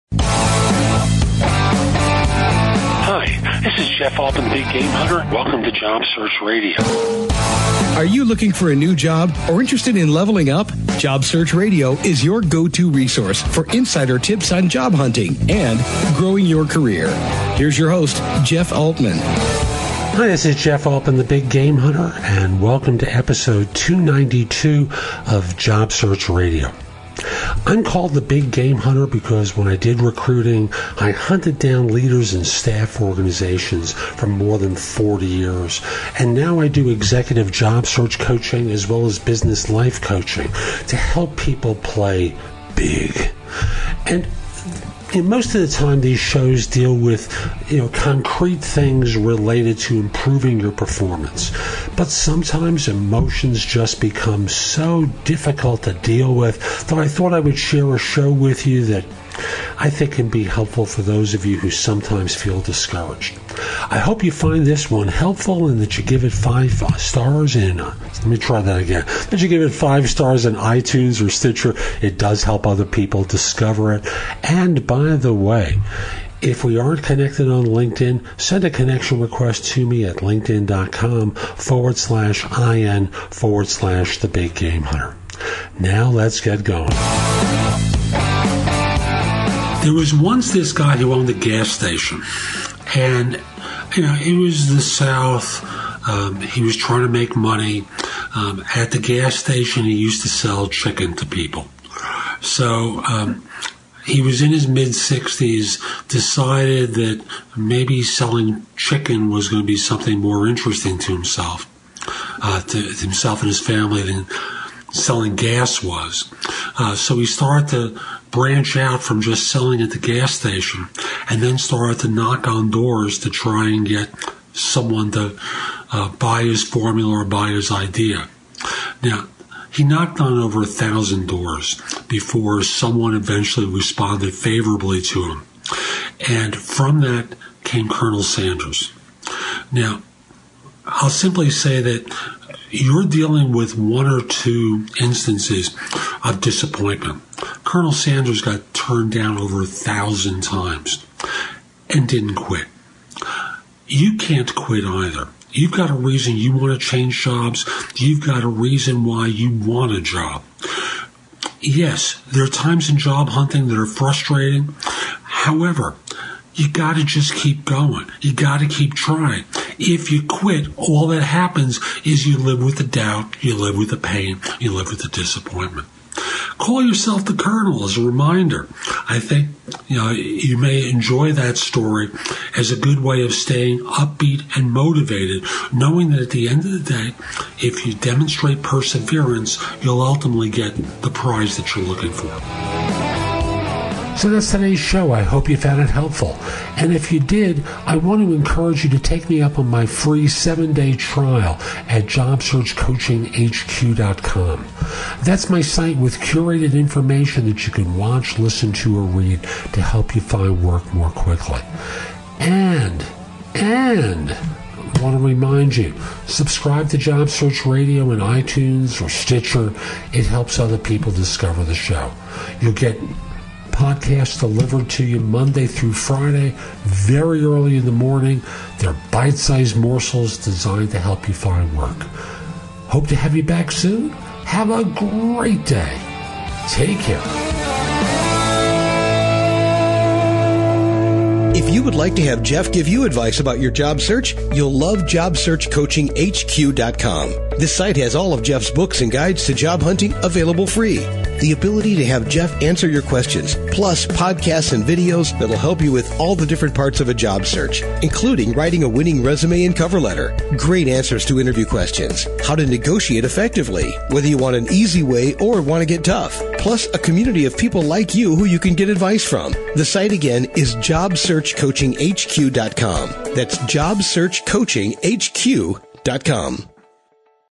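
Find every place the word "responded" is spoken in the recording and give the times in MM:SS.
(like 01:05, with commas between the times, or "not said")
02:13.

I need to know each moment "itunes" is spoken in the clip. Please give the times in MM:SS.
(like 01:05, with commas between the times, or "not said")
01:10, 03:38.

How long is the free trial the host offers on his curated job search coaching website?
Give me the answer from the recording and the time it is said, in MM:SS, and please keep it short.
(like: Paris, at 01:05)
seven day, at 03:20.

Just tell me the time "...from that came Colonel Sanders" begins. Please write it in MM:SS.
02:16.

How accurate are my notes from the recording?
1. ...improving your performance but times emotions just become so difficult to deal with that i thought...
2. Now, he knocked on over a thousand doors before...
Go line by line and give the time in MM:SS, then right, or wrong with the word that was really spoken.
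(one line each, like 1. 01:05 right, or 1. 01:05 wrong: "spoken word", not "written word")
1. 00:49 wrong: "sometimes", not "times"
2. 02:09 right.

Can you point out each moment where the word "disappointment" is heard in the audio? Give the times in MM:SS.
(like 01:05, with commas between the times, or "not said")
02:26, 02:55.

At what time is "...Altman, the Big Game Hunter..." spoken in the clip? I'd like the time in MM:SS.
00:20.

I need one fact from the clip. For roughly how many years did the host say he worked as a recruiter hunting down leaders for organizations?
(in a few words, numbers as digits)
40.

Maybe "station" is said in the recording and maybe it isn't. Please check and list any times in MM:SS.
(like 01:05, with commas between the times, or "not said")
01:31, 01:39, 02:00.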